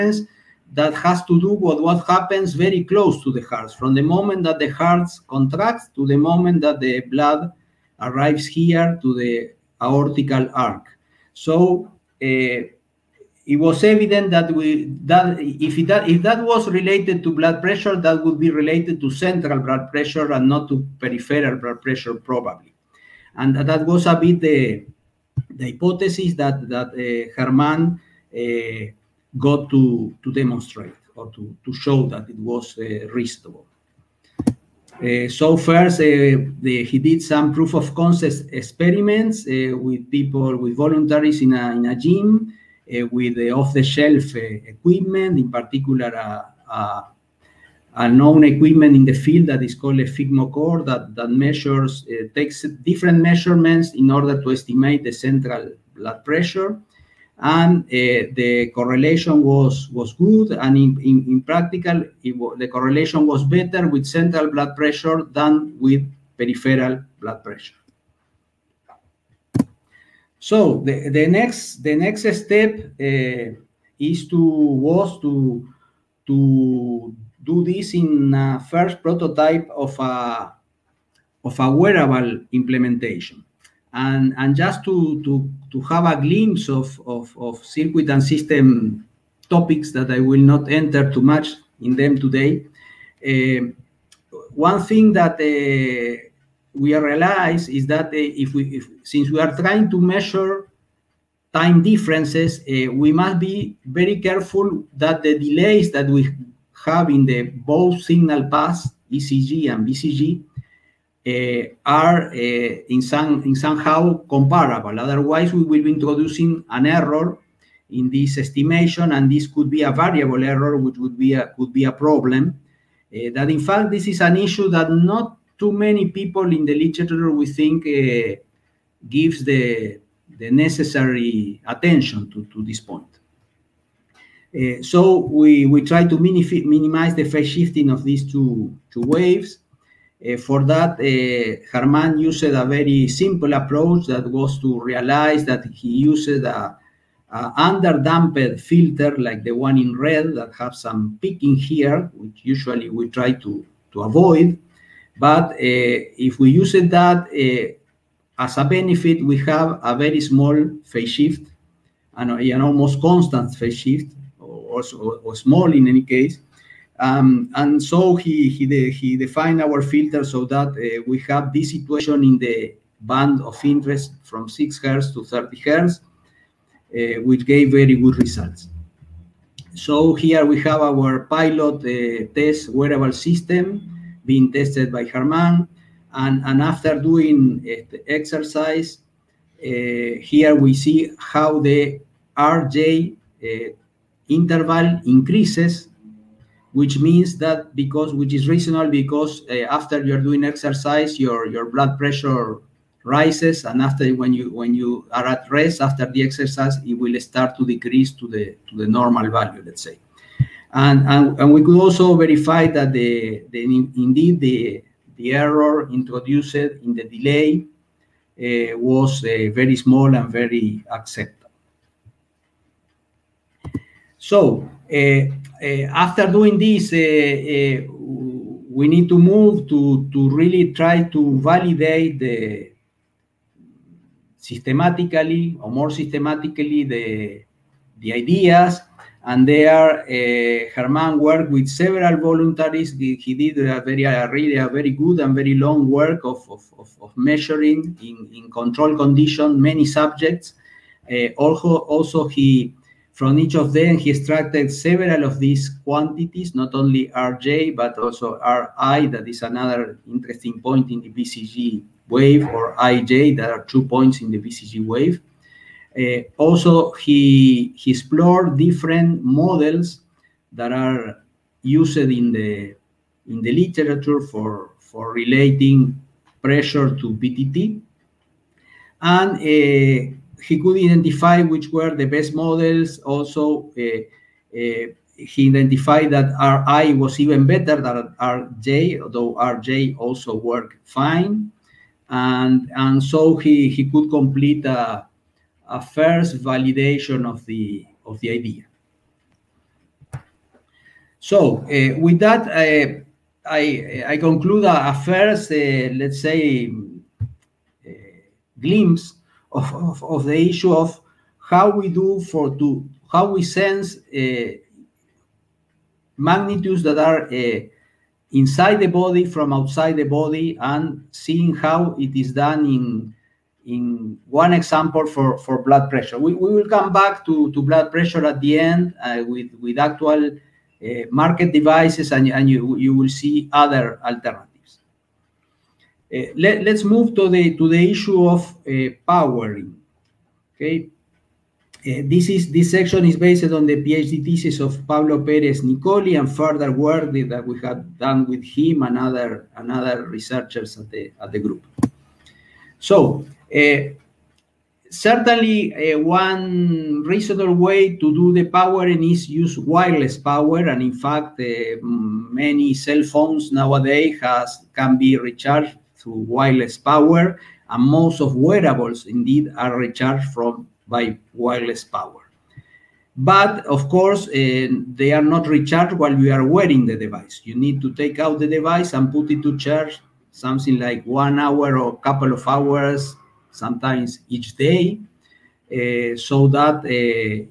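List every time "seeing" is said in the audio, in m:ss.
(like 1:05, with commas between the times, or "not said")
5:21.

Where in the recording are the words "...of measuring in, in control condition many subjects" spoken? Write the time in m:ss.
4:07.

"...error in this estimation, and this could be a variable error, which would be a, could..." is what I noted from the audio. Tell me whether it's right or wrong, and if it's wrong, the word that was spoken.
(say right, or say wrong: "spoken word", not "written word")
right.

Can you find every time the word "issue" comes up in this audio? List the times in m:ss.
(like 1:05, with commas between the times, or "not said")
2:04, 5:10, 5:37.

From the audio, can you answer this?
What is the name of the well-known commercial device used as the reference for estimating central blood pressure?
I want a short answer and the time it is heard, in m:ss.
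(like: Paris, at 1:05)
core, at 0:49.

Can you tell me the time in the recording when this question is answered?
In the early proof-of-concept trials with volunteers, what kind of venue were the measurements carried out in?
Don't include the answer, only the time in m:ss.
0:41.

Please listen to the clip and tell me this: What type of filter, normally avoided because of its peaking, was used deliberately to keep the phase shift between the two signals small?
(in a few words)
underdamped filter.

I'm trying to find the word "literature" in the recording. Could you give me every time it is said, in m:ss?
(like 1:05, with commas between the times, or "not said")
2:06, 4:33.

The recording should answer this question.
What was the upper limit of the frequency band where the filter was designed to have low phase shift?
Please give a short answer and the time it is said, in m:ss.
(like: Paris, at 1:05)
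30 hertz, at 2:55.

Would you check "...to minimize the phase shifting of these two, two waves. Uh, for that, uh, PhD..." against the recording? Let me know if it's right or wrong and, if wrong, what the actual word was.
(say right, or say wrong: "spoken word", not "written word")
wrong: "Germán", not "PhD".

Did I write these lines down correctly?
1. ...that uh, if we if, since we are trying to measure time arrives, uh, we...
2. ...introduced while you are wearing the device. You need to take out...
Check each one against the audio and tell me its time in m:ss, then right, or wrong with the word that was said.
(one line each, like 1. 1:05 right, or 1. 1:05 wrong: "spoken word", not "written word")
1. 1:37 wrong: "differences", not "arrives"
2. 6:15 wrong: "recharged", not "introduced".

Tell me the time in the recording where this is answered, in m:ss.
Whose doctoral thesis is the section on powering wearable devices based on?
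5:44.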